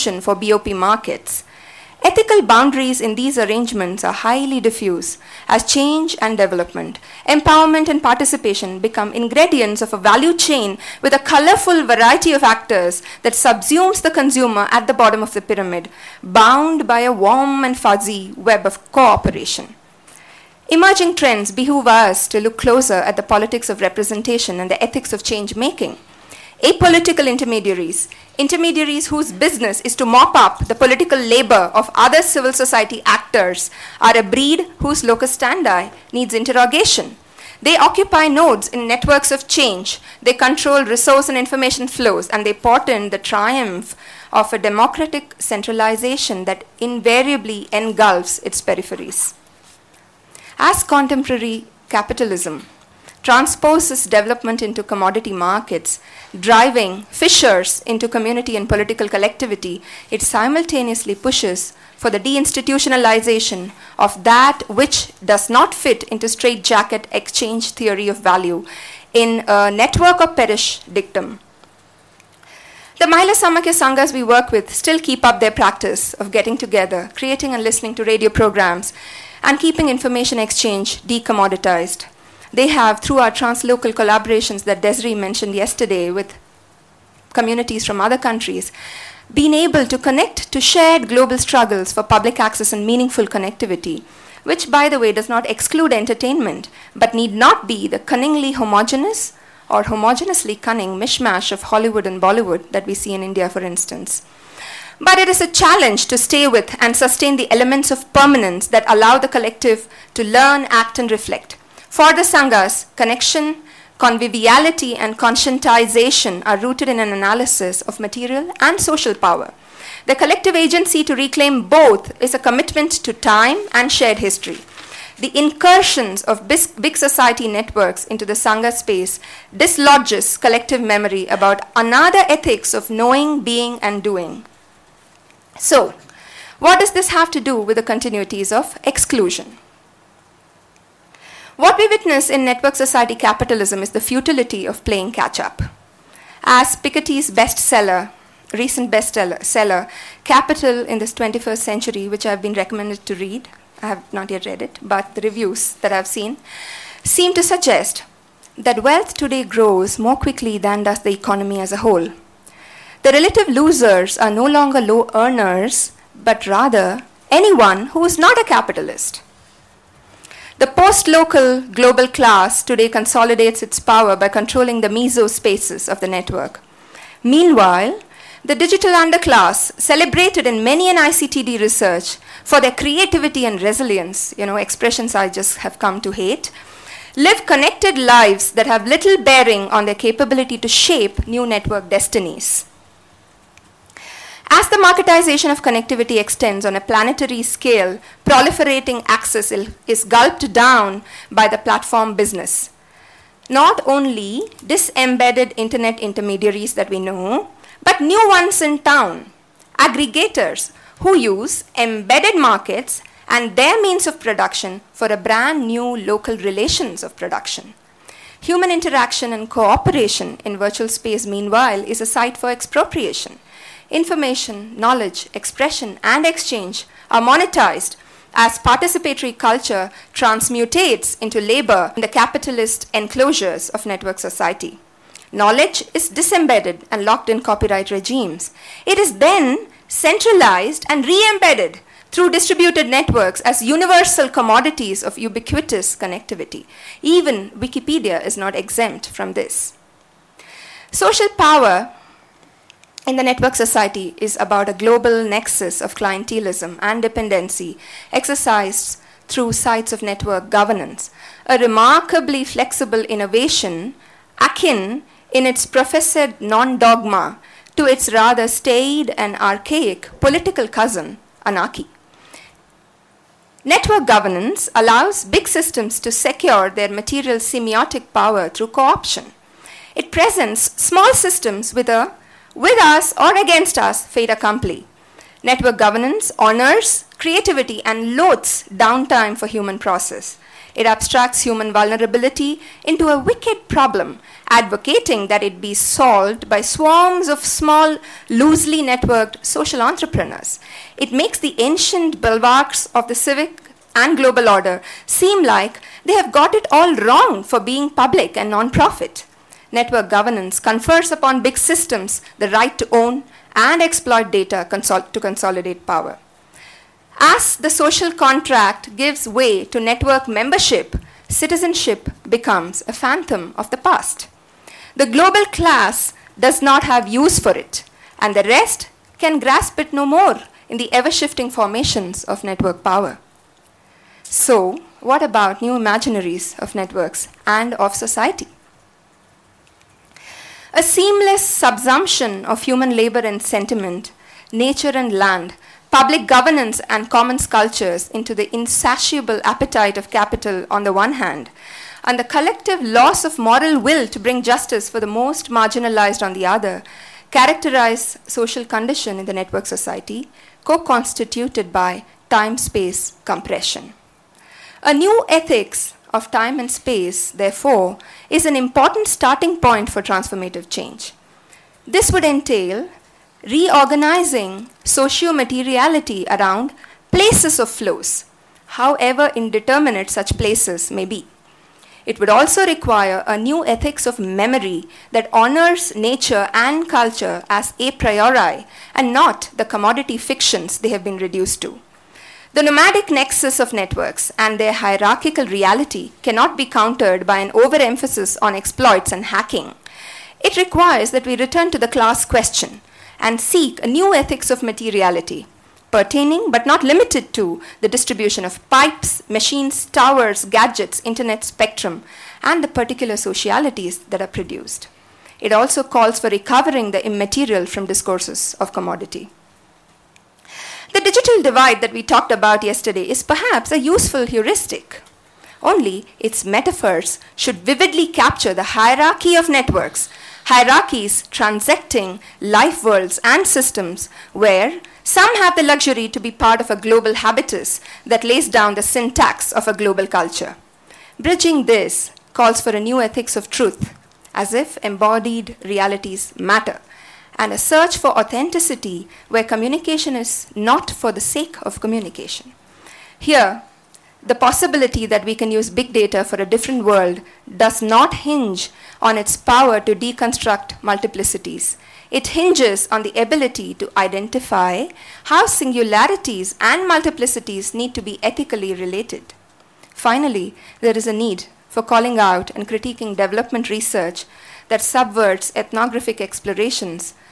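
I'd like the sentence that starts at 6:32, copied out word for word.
The nomadic nexus of networks and their hierarchical reality cannot be countered by an overemphasis on exploits and hacking.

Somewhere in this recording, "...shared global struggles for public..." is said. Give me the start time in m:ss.
1:30.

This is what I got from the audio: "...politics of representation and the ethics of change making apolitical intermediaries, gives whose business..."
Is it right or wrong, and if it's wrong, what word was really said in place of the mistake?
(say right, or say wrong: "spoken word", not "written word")
wrong: "intermediaries", not "gives".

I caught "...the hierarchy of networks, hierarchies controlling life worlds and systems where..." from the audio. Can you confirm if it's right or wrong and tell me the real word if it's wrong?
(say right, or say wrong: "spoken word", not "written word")
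wrong: "transacting", not "controlling".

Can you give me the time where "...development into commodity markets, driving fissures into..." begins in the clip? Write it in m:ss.
0:54.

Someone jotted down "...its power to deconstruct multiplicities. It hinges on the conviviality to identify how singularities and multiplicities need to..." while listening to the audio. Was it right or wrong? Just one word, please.
wrong.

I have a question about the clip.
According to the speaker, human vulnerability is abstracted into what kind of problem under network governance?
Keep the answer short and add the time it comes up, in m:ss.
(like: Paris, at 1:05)
a wicked problem, at 4:53.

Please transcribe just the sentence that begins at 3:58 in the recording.
It is then centralized and re-embedded through distributed networks as universal commodities of ubiquitous connectivity.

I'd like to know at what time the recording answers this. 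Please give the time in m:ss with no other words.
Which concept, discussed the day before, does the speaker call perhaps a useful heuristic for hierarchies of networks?
7:00.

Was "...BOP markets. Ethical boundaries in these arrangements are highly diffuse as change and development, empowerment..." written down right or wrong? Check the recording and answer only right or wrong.
right.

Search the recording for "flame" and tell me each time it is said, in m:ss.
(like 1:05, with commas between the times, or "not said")
not said.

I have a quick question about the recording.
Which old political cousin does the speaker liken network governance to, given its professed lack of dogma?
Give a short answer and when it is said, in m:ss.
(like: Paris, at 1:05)
anarchy, at 4:31.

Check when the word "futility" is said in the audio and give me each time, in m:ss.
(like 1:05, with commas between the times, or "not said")
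2:23.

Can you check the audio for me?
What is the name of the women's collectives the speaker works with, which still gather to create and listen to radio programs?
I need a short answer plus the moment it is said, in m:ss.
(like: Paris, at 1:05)
Mahila Samakhya Sanghas, at 1:13.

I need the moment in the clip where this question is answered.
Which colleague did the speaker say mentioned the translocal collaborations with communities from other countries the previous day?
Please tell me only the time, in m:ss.
1:24.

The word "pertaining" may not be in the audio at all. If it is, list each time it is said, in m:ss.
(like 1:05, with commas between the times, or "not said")
6:45.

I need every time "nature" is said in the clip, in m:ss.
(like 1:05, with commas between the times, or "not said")
5:44, 6:25.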